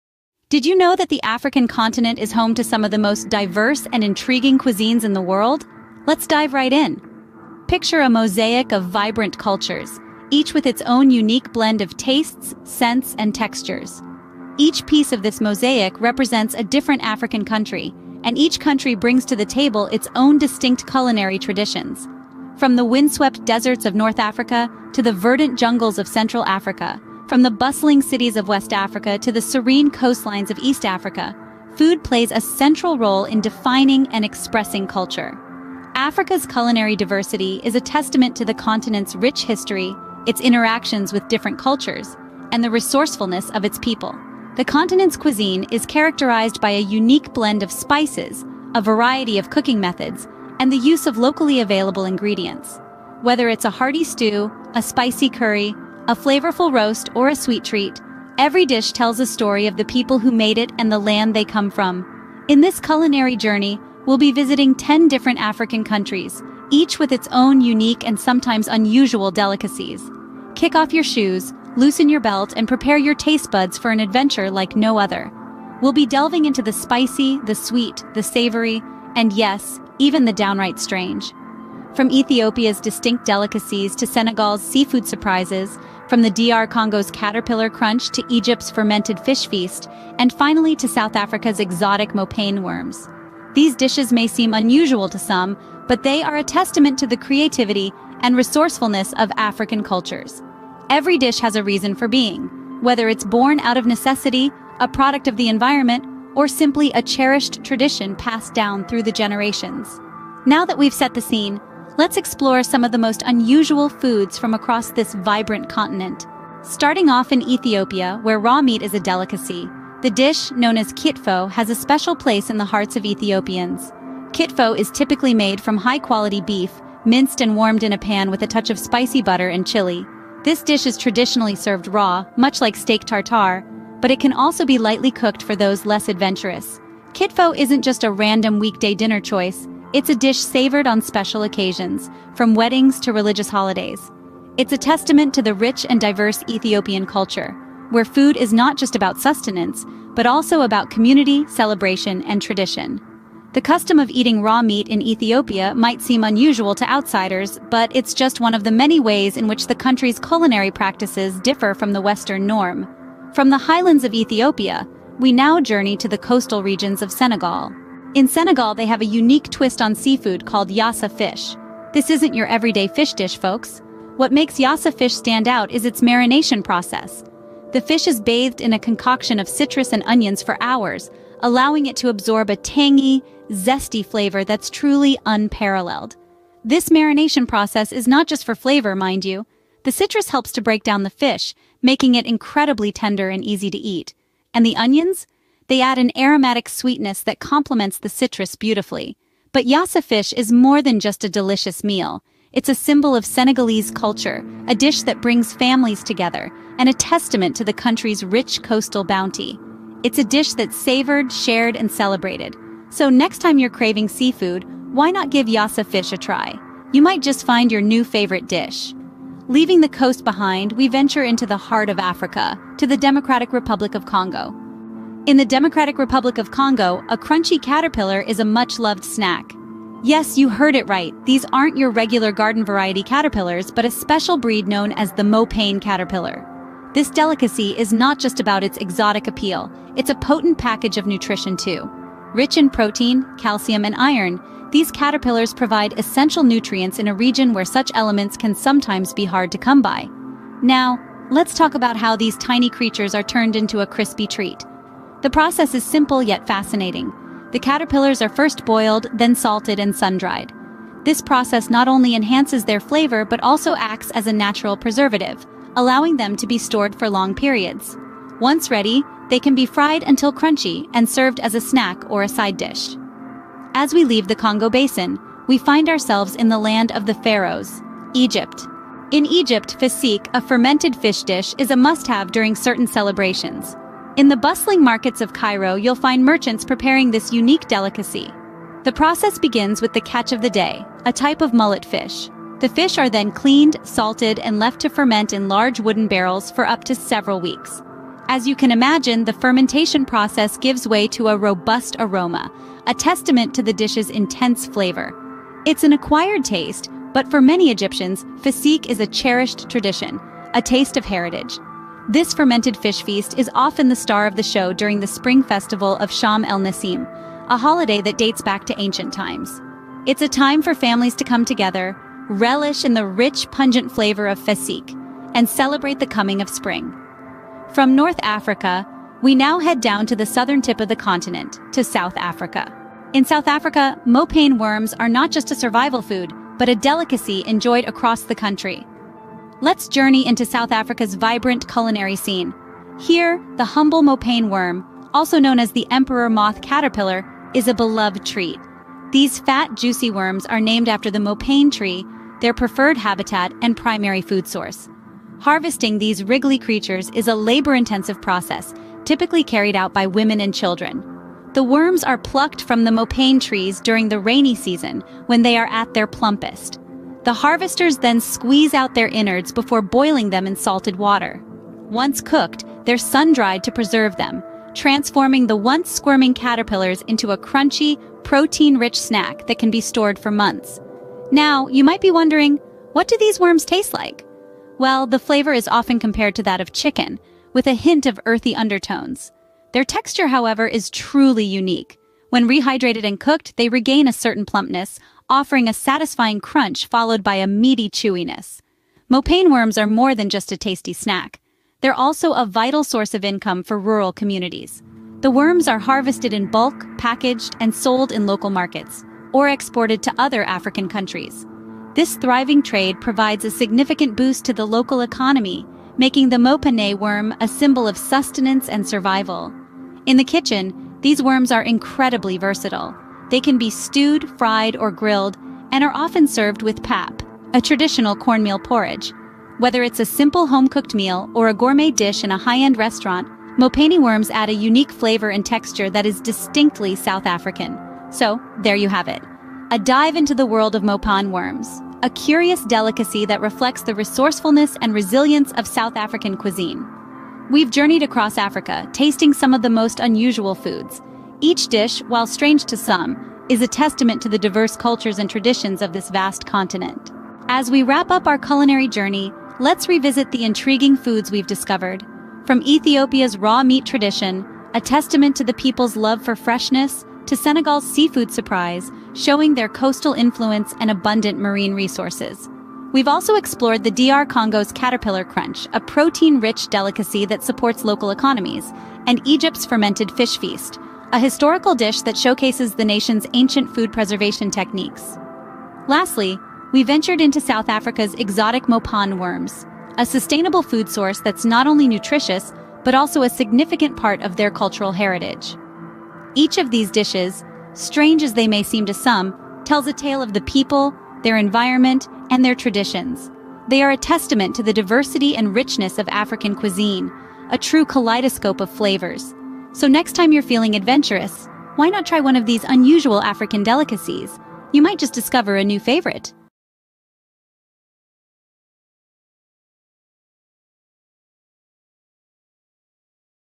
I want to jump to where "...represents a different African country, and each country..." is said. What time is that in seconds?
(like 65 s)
16 s.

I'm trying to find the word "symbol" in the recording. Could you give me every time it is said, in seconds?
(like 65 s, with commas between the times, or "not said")
202 s, 417 s.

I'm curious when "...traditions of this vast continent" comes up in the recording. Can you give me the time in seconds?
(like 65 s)
455 s.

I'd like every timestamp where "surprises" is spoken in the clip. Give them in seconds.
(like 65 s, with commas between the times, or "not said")
85 s, 468 s.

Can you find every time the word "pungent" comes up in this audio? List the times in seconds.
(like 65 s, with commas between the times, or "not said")
323 s.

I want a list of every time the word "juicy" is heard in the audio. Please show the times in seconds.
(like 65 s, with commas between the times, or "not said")
349 s.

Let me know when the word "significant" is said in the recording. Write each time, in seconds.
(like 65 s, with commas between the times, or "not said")
413 s, 493 s.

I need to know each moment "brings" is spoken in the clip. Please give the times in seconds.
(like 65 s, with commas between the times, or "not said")
18 s, 205 s.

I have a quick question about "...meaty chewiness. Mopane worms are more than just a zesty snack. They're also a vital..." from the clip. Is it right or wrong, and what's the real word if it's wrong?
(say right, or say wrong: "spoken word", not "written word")
wrong: "tasty", not "zesty".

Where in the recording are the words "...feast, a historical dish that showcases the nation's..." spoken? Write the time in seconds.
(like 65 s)
480 s.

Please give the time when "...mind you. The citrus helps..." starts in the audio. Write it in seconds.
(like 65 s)
188 s.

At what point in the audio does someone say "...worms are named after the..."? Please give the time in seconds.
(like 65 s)
350 s.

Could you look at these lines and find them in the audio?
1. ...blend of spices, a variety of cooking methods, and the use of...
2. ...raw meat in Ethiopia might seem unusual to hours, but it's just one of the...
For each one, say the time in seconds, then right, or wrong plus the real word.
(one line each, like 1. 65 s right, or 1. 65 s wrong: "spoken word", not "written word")
1. 47 s right
2. 154 s wrong: "outsiders", not "hours".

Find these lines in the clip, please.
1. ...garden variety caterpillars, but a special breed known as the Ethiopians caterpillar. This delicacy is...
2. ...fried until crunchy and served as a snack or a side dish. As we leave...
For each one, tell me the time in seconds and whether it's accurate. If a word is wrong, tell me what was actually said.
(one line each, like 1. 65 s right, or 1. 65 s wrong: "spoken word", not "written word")
1. 232 s wrong: "Mopane", not "Ethiopians"
2. 269 s right.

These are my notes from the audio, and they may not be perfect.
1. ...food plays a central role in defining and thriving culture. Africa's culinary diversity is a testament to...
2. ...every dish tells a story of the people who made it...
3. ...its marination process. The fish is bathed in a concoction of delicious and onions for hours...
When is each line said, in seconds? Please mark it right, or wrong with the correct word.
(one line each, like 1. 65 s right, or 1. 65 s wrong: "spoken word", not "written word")
1. 31 s wrong: "expressing", not "thriving"
2. 58 s right
3. 175 s wrong: "citrus", not "delicious".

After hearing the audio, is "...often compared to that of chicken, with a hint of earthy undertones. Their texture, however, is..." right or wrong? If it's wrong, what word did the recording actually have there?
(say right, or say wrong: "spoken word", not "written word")
right.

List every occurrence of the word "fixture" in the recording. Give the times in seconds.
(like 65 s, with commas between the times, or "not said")
not said.